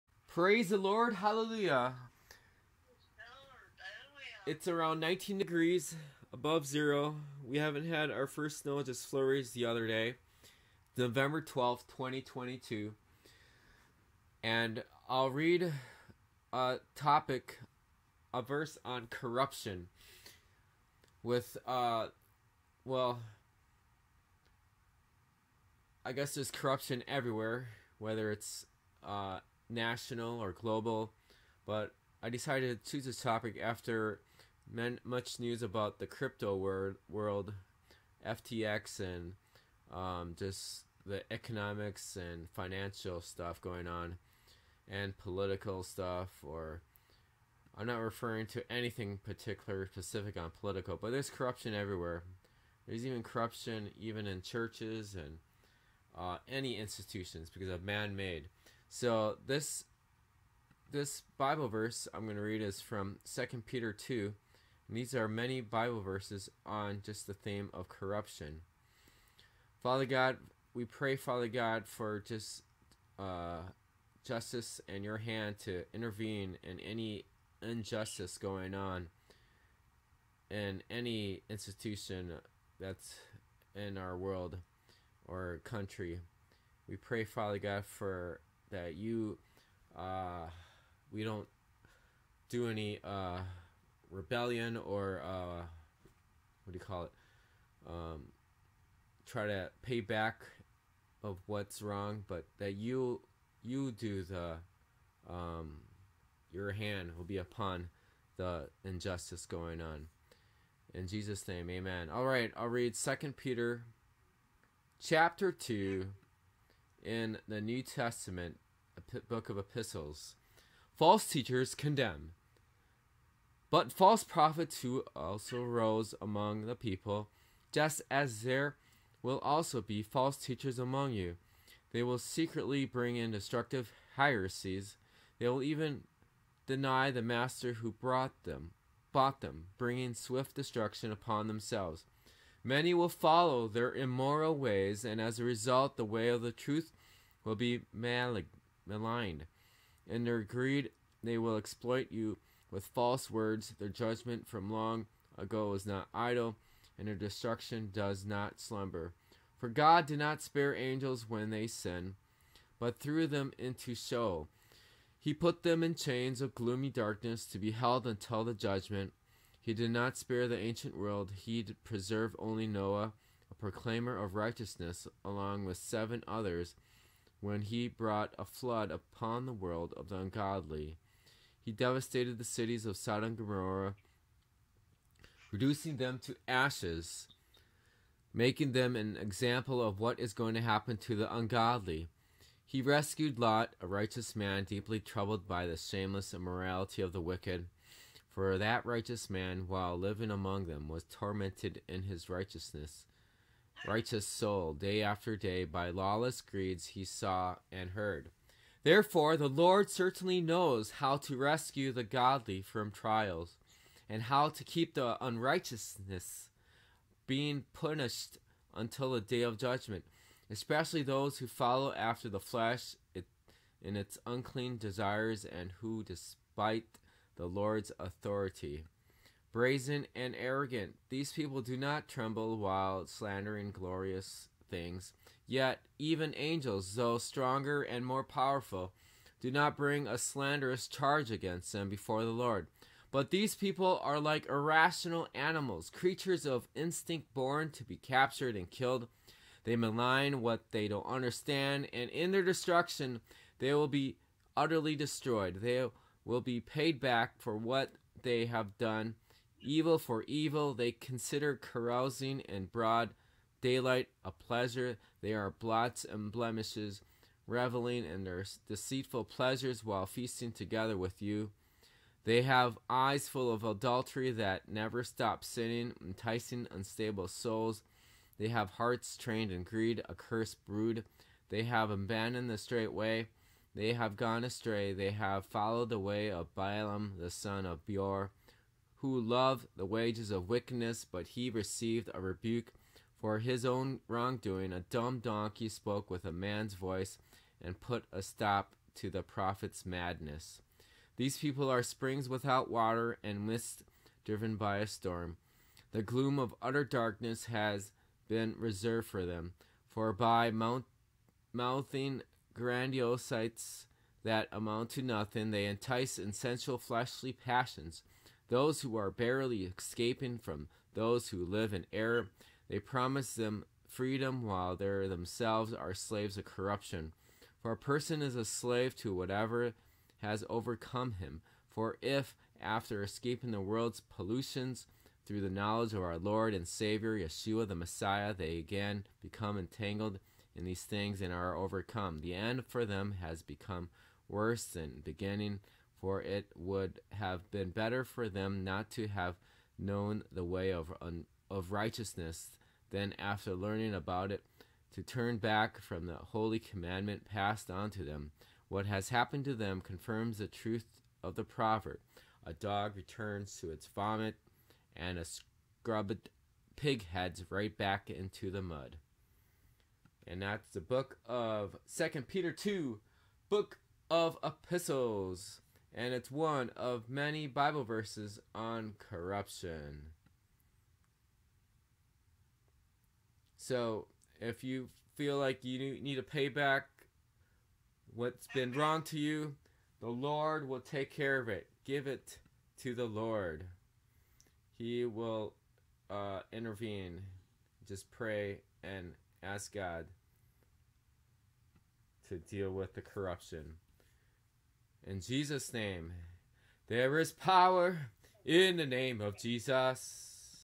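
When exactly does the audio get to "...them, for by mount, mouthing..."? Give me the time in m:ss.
5:09.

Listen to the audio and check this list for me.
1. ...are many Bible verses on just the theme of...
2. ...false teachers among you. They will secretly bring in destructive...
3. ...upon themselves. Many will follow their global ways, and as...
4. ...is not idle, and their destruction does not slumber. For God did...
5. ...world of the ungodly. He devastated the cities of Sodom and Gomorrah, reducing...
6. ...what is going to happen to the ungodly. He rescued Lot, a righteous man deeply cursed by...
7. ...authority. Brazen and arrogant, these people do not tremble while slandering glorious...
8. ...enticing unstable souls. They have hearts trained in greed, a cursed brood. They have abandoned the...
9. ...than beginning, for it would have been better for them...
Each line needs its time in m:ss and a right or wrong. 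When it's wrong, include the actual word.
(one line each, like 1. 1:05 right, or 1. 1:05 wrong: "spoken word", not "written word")
1. 1:05 right
2. 2:10 right
3. 2:21 wrong: "immoral", not "global"
4. 2:35 right
5. 2:59 right
6. 3:09 wrong: "troubled", not "cursed"
7. 3:47 right
8. 4:36 right
9. 5:44 right.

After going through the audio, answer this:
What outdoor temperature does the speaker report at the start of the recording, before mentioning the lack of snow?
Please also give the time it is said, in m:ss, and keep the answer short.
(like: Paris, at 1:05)
19 degrees, at 0:05.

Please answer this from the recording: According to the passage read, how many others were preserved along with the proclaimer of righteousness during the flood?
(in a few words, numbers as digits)
7.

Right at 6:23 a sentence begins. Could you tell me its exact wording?
So, if you feel like you need to pay back what's been wrong to you, the Lord will take care of it.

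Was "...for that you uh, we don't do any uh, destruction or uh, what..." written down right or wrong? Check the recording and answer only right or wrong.
wrong.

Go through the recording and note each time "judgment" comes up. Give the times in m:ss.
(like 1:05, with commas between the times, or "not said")
2:33, 2:48, 3:39.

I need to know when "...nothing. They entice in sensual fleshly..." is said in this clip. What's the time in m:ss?
5:15.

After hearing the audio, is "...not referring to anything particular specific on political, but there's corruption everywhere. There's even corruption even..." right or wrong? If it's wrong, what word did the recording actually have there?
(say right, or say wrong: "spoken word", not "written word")
right.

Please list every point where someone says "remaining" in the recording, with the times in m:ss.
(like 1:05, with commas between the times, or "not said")
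not said.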